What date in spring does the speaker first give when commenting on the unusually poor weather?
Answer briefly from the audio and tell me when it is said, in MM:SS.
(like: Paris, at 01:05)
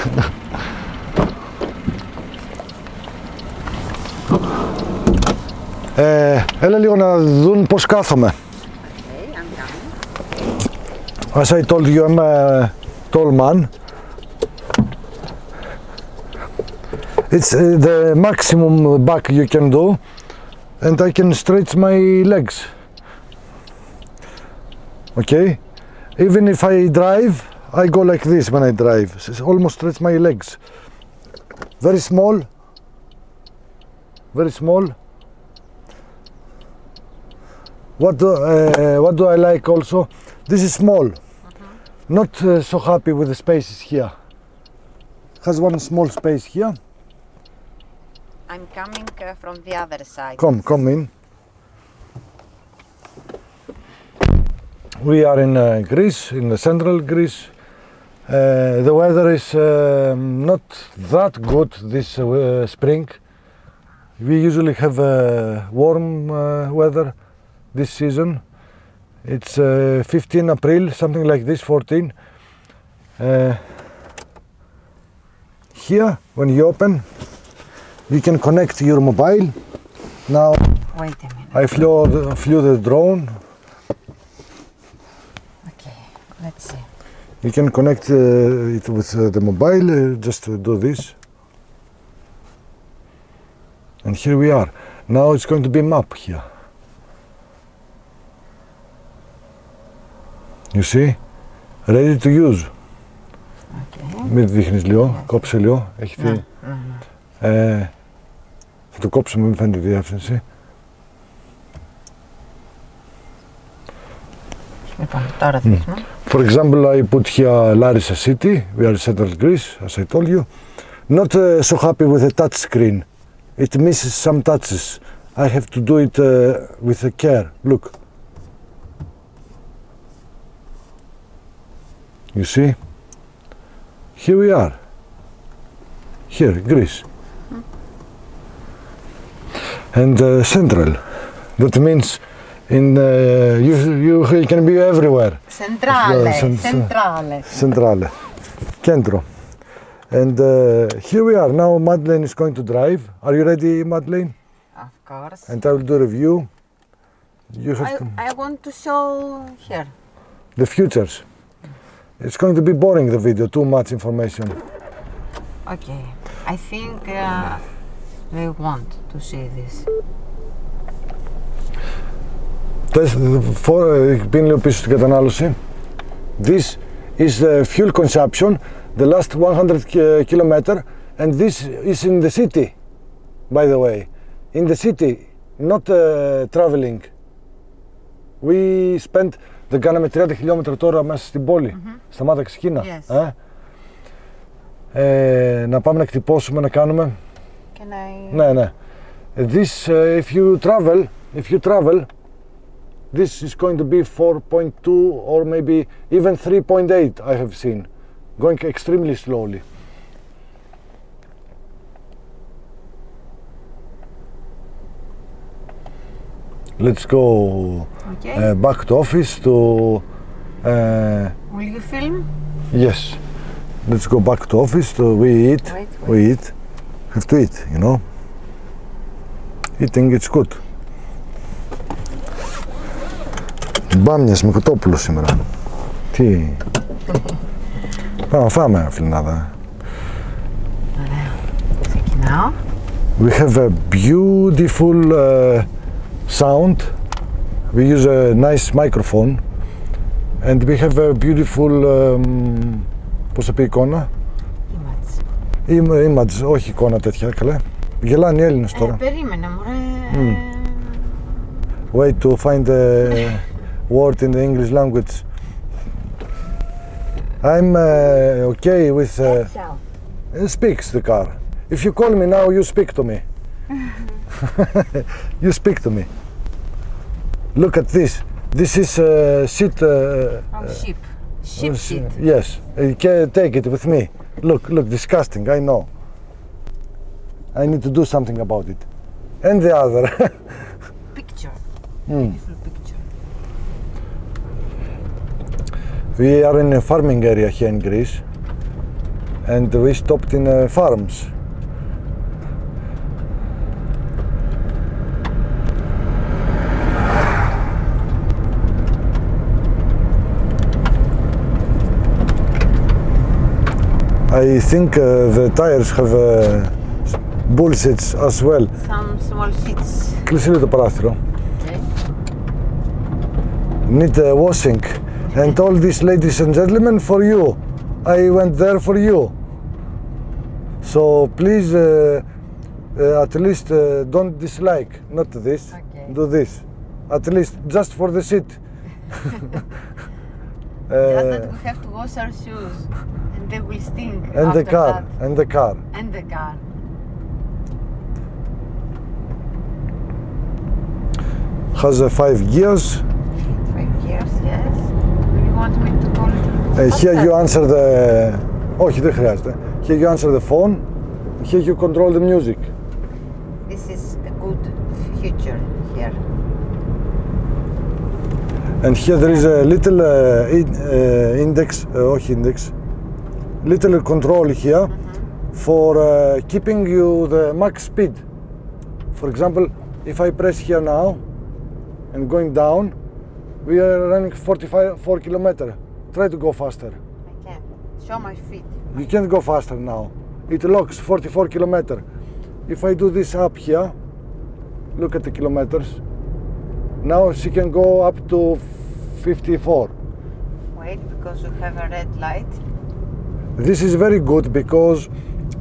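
15 April, at 01:10.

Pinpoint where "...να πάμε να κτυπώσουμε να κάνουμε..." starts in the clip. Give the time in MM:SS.
03:15.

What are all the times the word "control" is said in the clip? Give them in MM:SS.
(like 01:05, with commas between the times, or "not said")
06:01, 06:14.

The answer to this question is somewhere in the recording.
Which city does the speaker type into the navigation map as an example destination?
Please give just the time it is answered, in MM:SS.
01:57.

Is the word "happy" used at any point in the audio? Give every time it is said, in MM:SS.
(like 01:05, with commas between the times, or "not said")
00:42, 02:01.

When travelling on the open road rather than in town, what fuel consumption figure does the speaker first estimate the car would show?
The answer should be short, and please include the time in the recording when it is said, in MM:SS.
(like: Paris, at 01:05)
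4.2, at 03:24.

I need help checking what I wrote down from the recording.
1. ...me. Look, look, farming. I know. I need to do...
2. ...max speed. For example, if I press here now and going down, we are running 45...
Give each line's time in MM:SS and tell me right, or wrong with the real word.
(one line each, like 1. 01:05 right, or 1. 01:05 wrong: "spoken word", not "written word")
1. 04:43 wrong: "disgusting", not "farming"
2. 06:17 right.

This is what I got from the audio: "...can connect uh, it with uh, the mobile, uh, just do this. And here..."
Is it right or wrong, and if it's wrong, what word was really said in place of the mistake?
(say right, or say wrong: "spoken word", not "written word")
right.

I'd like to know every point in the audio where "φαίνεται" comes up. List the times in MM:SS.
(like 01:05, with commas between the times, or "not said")
01:49.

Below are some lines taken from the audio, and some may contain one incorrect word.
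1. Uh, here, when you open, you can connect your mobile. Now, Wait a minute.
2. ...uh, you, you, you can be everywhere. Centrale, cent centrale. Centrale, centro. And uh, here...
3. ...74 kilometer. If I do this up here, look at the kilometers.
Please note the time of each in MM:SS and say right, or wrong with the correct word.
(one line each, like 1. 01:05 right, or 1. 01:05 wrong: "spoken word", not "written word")
1. 01:13 right
2. 02:23 right
3. 06:30 wrong: "44", not "74".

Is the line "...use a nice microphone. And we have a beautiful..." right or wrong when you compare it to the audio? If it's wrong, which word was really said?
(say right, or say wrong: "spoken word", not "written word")
right.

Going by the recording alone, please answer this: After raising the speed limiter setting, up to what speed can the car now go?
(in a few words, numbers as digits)
54.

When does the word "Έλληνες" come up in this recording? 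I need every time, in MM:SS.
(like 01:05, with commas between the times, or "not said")
04:18.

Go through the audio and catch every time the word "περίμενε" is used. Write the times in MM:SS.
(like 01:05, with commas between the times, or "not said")
04:18.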